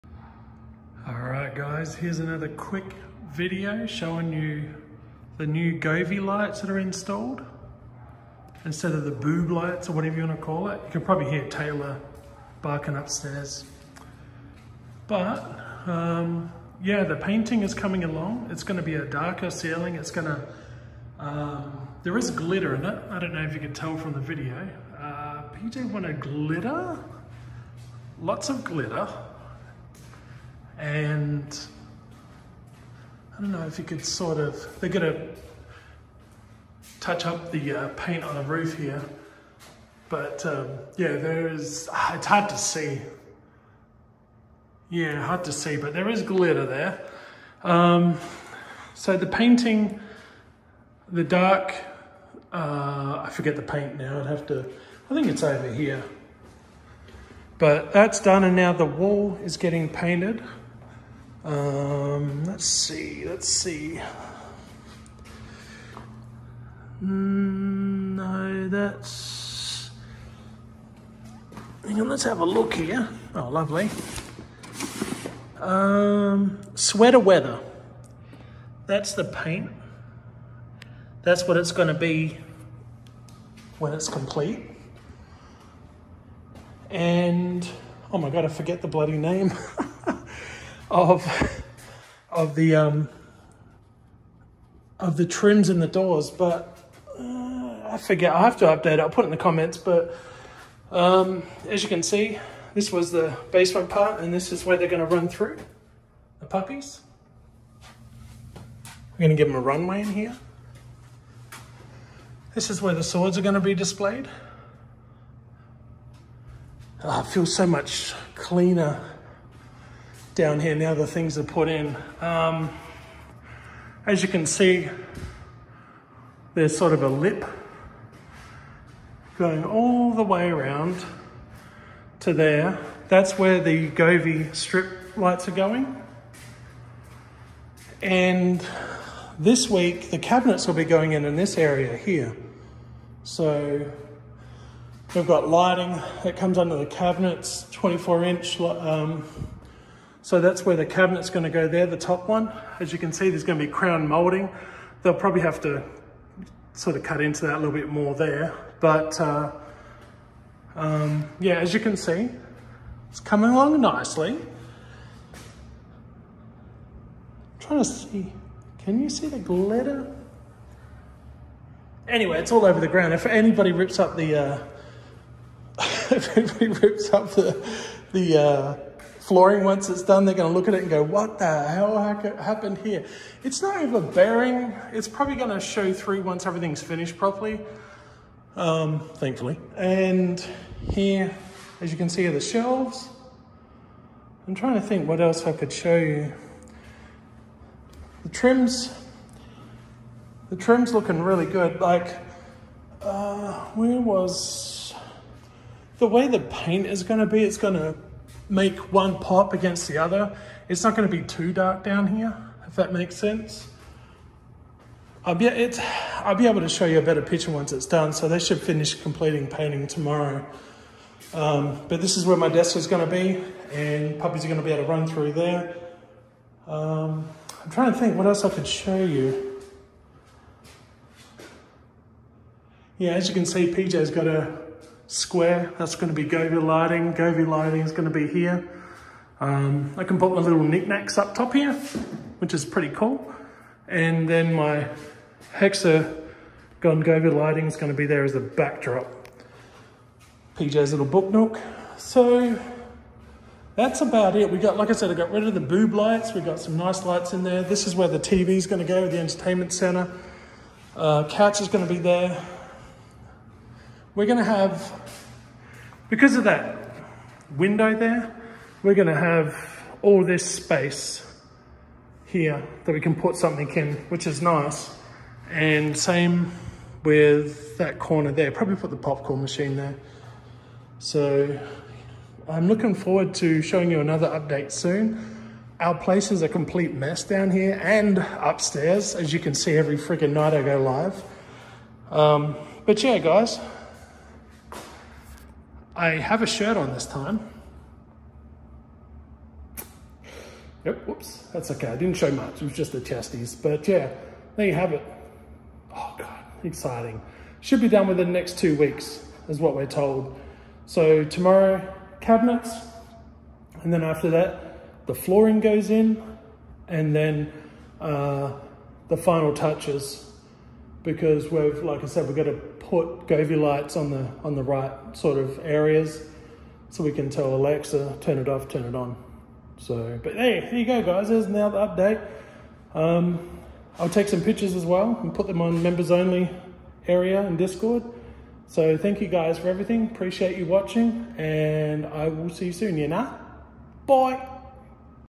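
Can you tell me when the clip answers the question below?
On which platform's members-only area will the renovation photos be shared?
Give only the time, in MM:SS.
05:37.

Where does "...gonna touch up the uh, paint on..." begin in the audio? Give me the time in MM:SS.
00:34.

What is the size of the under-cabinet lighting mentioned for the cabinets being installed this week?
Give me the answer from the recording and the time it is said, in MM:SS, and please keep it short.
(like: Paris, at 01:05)
24 inch, at 02:27.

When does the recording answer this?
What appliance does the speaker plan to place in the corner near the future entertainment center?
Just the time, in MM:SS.
04:38.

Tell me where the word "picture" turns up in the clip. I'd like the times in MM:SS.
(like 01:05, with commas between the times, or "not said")
03:37, 05:34.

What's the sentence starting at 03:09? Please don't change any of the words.
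And here, as you can see, are the shelves.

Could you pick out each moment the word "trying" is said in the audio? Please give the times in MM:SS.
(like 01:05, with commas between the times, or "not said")
02:47, 03:14, 03:47.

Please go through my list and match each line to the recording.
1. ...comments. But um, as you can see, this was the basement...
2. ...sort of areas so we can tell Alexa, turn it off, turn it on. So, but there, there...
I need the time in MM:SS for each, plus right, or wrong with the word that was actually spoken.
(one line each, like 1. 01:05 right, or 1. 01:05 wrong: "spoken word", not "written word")
1. 01:39 right
2. 05:25 right.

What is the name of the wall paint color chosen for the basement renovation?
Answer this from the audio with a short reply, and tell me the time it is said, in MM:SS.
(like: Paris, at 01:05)
Sweater Weather, at 01:16.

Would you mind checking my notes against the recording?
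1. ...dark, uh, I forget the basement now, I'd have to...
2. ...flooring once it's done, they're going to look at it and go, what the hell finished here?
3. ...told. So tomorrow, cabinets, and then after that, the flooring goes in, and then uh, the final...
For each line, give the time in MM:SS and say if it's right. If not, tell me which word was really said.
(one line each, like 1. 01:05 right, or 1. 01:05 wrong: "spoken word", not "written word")
1. 00:51 wrong: "paint", not "basement"
2. 02:59 wrong: "happened", not "finished"
3. 05:09 right.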